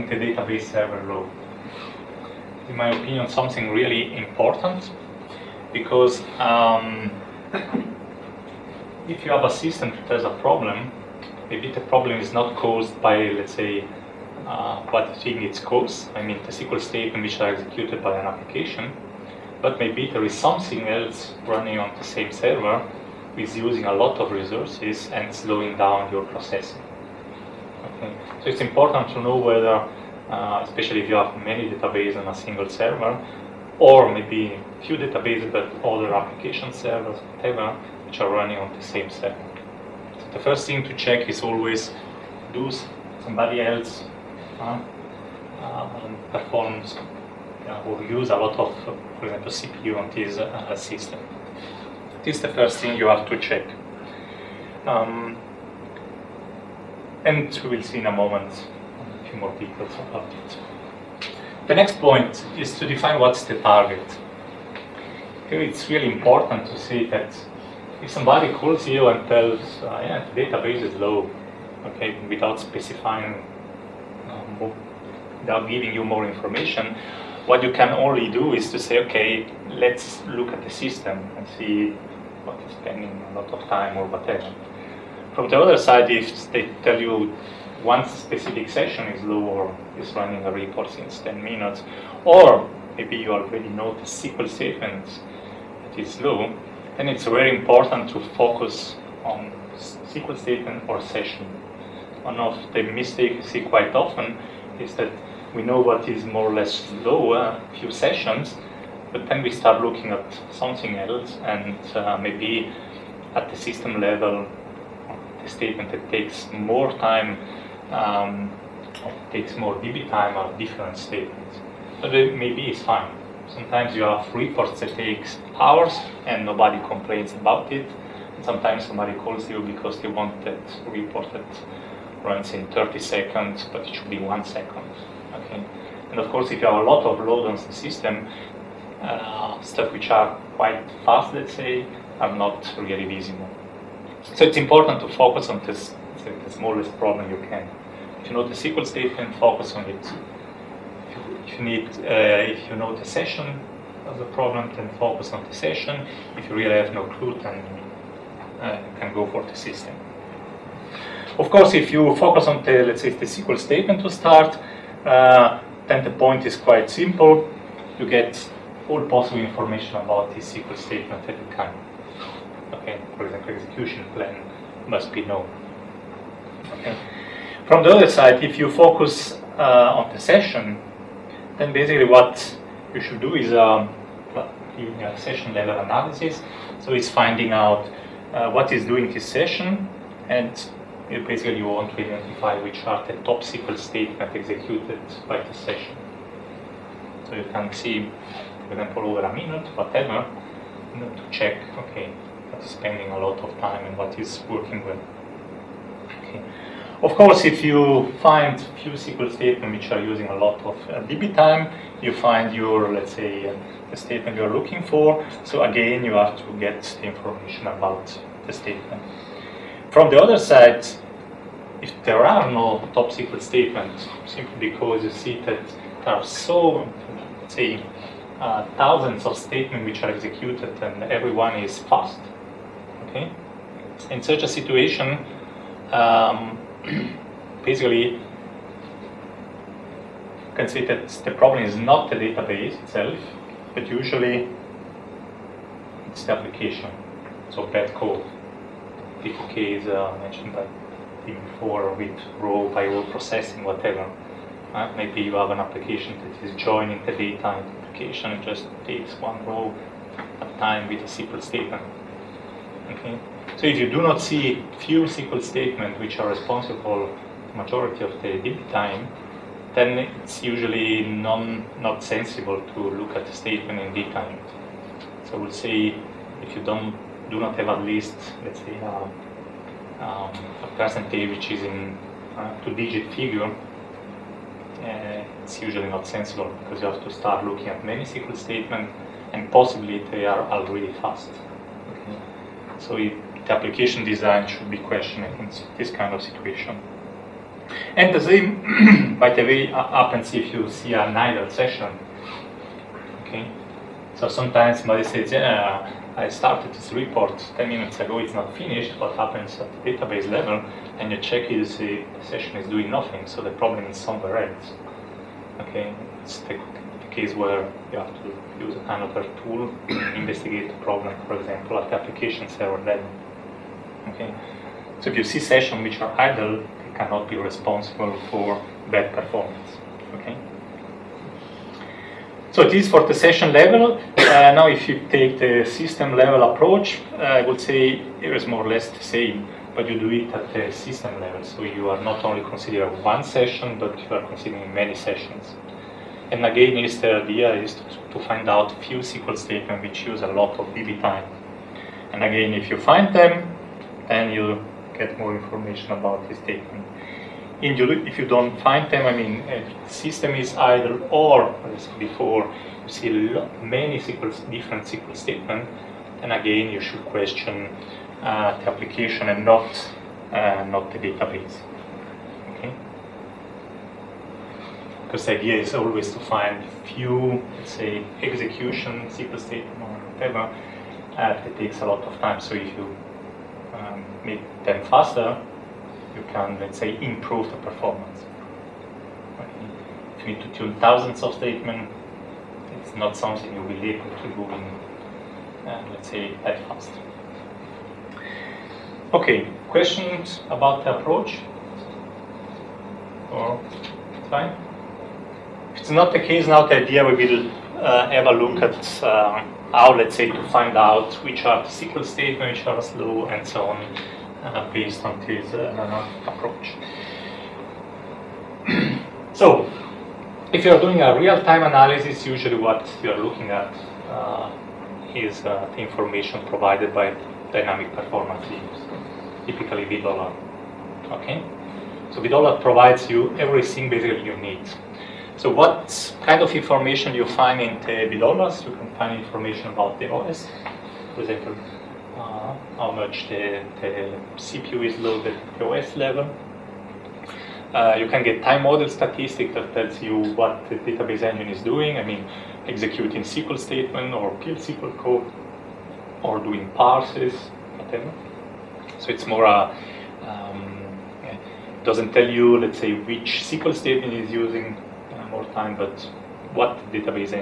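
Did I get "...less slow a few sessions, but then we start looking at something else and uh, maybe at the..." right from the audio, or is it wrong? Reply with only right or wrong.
right.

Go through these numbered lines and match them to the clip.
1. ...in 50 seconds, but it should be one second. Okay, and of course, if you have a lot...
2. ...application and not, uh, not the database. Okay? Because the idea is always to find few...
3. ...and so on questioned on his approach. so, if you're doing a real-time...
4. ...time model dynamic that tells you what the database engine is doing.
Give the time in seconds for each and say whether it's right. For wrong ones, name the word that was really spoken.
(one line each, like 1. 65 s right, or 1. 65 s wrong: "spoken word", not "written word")
1. 132 s wrong: "30", not "50"
2. 368 s right
3. 413 s wrong: "based", not "questioned"
4. 448 s wrong: "statistic", not "dynamic".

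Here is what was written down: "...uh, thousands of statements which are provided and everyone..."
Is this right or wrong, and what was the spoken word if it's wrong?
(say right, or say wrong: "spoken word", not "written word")
wrong: "executed", not "provided".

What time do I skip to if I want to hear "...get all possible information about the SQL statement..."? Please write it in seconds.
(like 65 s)
168 s.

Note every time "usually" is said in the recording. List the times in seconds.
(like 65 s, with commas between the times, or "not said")
243 s, 270 s, 285 s, 422 s.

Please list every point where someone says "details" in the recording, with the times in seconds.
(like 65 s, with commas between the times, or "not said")
59 s, 273 s.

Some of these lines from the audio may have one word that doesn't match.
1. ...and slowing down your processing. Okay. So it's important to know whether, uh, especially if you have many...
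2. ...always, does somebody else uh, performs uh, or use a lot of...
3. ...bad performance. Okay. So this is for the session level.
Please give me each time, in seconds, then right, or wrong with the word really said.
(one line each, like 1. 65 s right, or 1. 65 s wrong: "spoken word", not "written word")
1. 25 s right
2. 41 s right
3. 328 s right.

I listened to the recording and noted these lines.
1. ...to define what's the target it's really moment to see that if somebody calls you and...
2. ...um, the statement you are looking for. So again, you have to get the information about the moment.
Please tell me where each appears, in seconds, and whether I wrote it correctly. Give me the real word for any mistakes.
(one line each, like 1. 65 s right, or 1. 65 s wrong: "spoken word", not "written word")
1. 62 s wrong: "important", not "moment"
2. 213 s wrong: "statement", not "moment".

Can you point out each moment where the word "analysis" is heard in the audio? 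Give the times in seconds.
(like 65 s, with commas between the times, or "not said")
185 s, 421 s.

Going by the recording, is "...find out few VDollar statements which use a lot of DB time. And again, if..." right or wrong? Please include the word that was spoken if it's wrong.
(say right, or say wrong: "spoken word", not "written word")
wrong: "SQL", not "VDollar".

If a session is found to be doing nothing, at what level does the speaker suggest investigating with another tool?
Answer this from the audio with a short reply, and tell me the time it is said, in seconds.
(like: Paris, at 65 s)
Application server, at 321 s.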